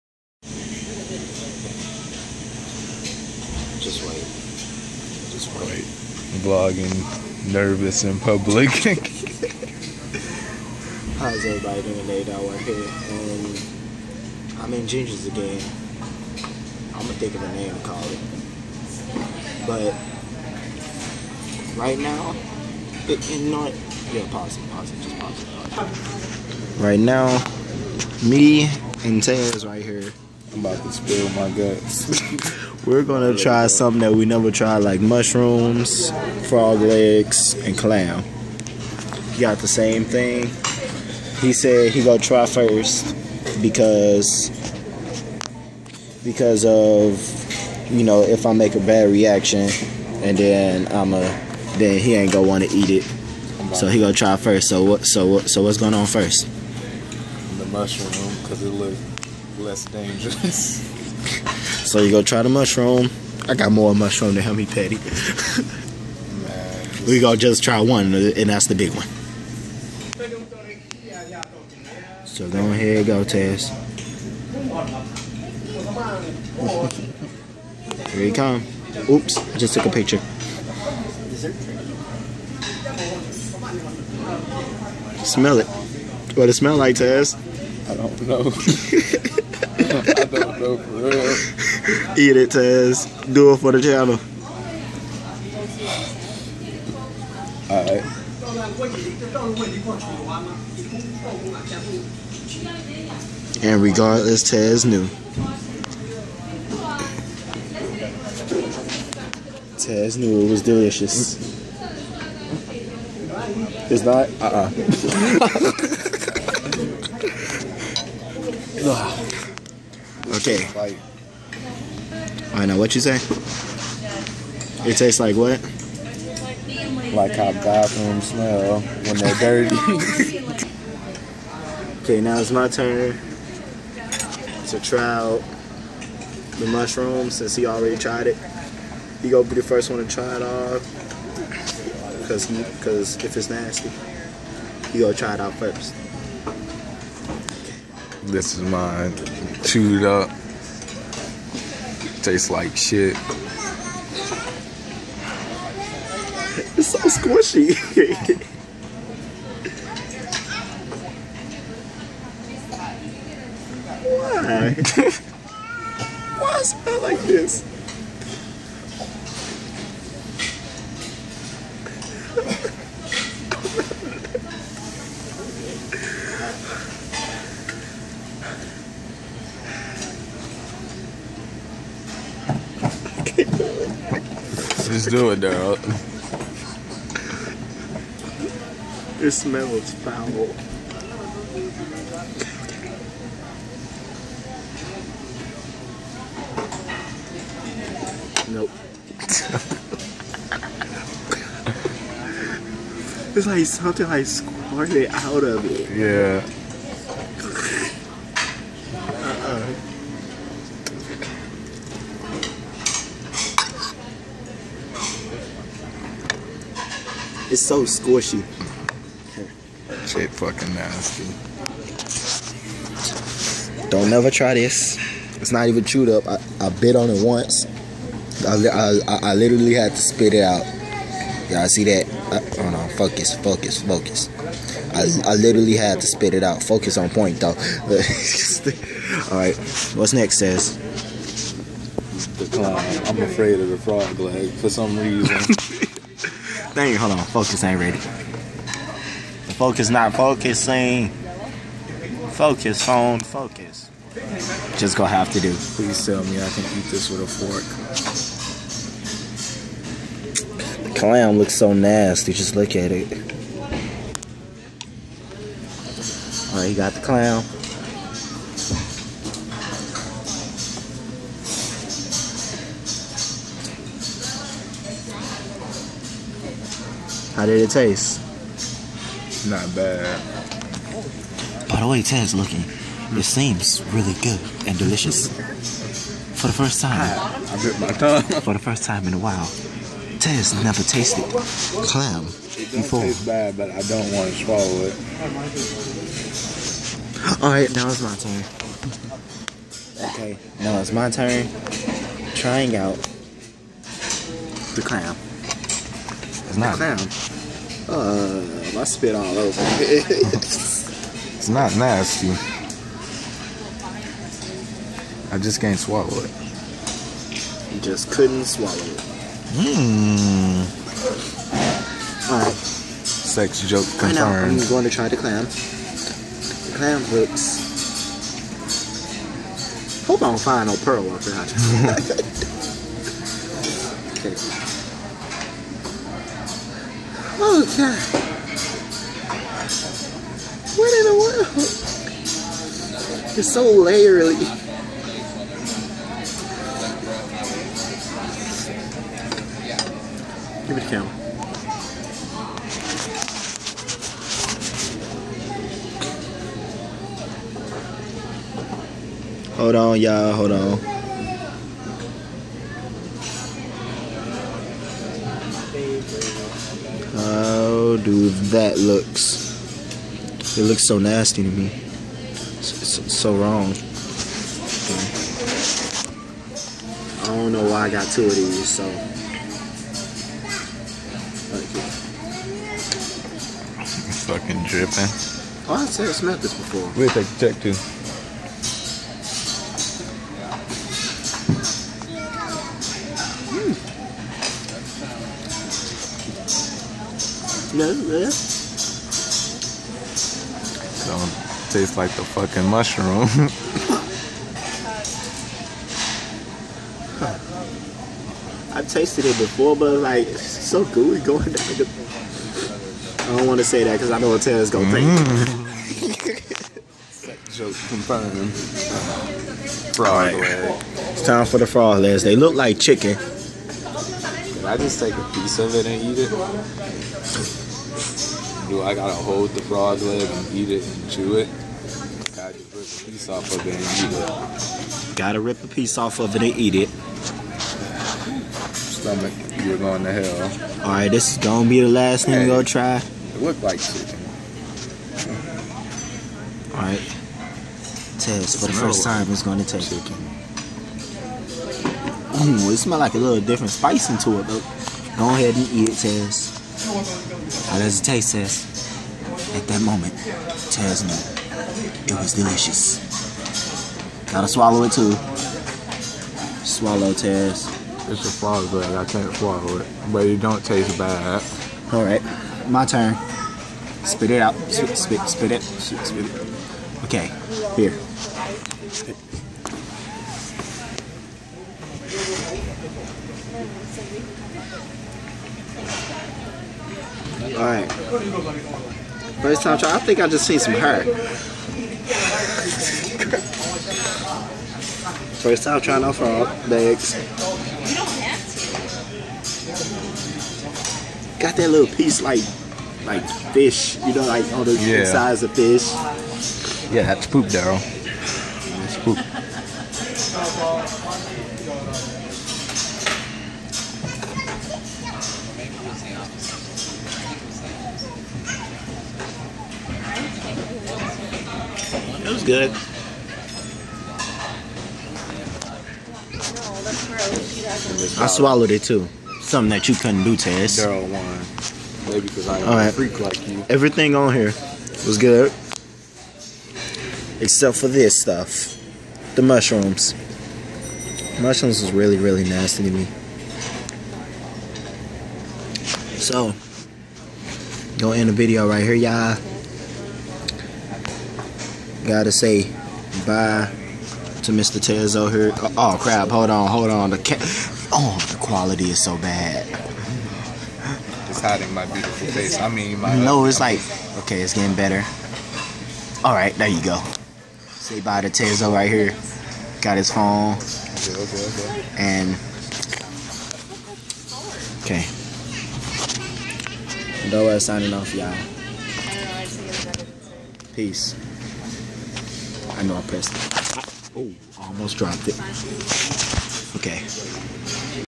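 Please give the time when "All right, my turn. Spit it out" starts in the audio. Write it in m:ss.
7:51.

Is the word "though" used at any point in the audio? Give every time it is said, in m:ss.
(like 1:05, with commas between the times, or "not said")
3:57, 7:34.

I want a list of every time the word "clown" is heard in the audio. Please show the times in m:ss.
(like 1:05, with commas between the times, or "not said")
4:02, 5:06.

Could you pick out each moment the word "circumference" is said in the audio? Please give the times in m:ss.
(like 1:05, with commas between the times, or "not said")
not said.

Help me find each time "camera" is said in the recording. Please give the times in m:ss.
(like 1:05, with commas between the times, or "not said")
5:50.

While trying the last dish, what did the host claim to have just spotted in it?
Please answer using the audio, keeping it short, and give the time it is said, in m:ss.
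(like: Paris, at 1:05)
Hair, at 8:10.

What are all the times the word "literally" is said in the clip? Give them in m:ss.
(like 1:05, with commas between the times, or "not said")
3:49, 3:55.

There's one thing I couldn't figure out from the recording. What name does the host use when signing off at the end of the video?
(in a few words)
Dora.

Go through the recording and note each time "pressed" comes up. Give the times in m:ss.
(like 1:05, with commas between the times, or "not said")
9:43.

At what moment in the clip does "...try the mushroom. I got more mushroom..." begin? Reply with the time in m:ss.
1:02.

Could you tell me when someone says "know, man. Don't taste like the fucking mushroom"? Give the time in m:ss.
6:37.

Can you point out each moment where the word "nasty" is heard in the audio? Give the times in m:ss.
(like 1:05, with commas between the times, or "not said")
2:23, 3:40, 4:21, 5:11, 6:10, 9:02.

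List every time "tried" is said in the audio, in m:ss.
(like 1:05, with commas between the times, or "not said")
0:34, 2:17.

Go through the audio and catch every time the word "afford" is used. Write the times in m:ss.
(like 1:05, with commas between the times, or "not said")
not said.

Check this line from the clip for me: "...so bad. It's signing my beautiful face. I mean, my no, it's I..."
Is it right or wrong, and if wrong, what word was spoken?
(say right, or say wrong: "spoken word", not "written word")
wrong: "hiding", not "signing".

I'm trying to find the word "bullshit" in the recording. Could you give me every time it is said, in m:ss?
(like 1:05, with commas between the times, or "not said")
not said.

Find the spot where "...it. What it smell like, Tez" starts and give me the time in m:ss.
1:25.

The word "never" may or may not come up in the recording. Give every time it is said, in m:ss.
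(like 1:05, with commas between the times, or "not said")
0:34, 3:44, 4:50.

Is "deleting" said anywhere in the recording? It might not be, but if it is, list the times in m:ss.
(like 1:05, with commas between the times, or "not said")
not said.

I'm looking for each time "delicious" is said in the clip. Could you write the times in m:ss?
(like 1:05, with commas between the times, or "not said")
1:50, 4:44, 7:42.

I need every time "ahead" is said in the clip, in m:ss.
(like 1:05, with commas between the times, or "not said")
1:12, 7:35.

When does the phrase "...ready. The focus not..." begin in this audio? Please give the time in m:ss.
4:07.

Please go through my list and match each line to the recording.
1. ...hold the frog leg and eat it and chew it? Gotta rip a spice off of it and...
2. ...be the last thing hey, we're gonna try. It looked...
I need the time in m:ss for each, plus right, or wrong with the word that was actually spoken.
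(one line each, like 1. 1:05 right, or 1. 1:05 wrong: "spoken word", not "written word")
1. 7:09 wrong: "piece", not "spice"
2. 7:21 right.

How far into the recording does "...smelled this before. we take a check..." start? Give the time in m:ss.
6:26.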